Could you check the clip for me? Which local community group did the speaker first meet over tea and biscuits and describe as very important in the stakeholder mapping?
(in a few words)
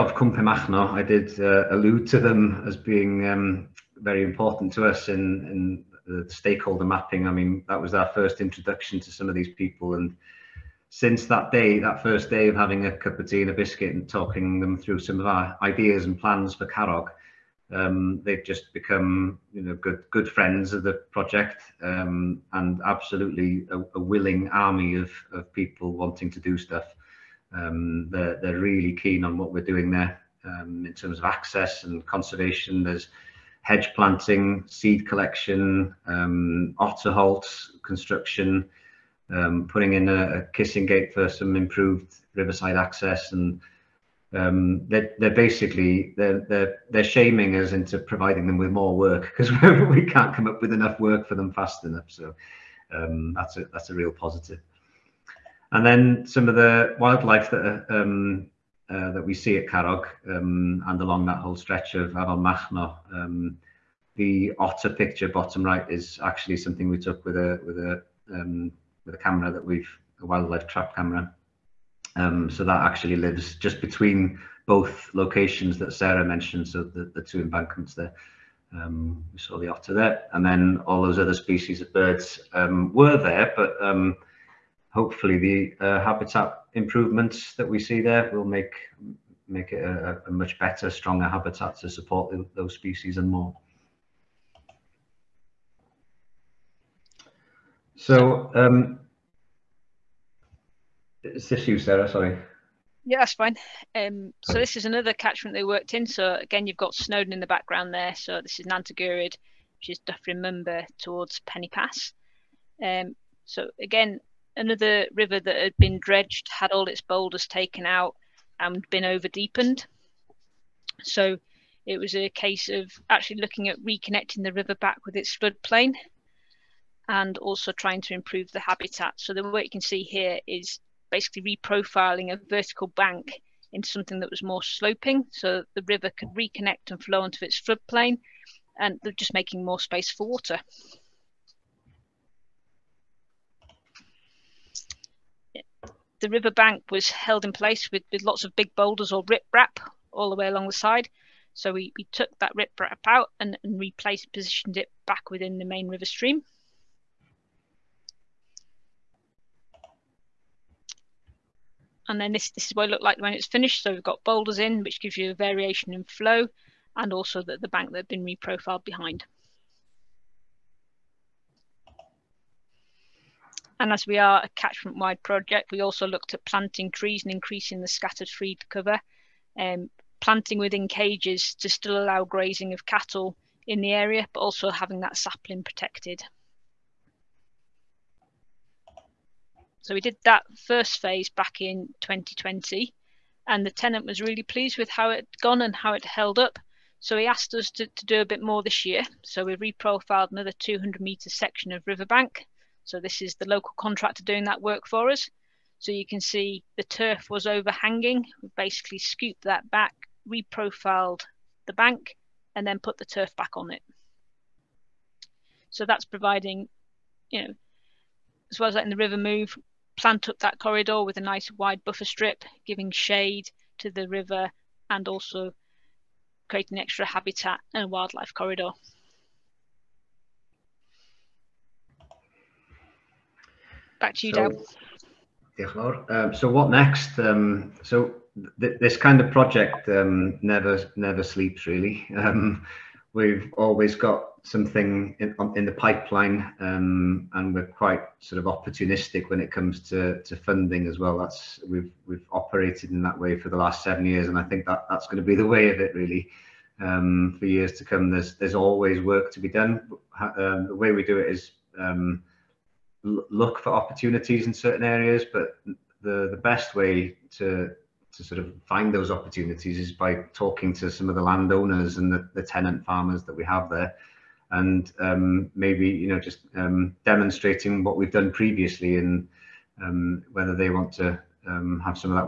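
Cwm Penmachno.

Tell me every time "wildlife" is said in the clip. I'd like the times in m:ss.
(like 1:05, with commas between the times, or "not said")
0:56, 1:10, 3:47.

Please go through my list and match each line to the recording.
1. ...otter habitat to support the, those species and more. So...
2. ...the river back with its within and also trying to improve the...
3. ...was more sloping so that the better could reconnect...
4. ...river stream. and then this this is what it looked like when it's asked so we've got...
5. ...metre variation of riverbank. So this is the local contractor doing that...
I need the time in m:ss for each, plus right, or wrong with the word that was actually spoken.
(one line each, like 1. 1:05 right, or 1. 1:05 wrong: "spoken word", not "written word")
1. 1:30 wrong: "stronger", not "otter"
2. 2:04 wrong: "floodplain", not "within"
3. 2:14 wrong: "river", not "better"
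4. 2:35 wrong: "finished", not "asked"
5. 3:21 wrong: "section", not "variation".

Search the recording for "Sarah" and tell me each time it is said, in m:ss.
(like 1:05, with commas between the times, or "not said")
1:15, 1:41.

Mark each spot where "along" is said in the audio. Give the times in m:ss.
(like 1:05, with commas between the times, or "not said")
1:01, 2:30.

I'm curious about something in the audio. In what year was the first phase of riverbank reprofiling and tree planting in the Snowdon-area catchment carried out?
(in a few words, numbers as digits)
2020.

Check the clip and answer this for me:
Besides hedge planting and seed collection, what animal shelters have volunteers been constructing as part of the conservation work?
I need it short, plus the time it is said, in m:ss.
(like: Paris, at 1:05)
Otter holts, at 0:36.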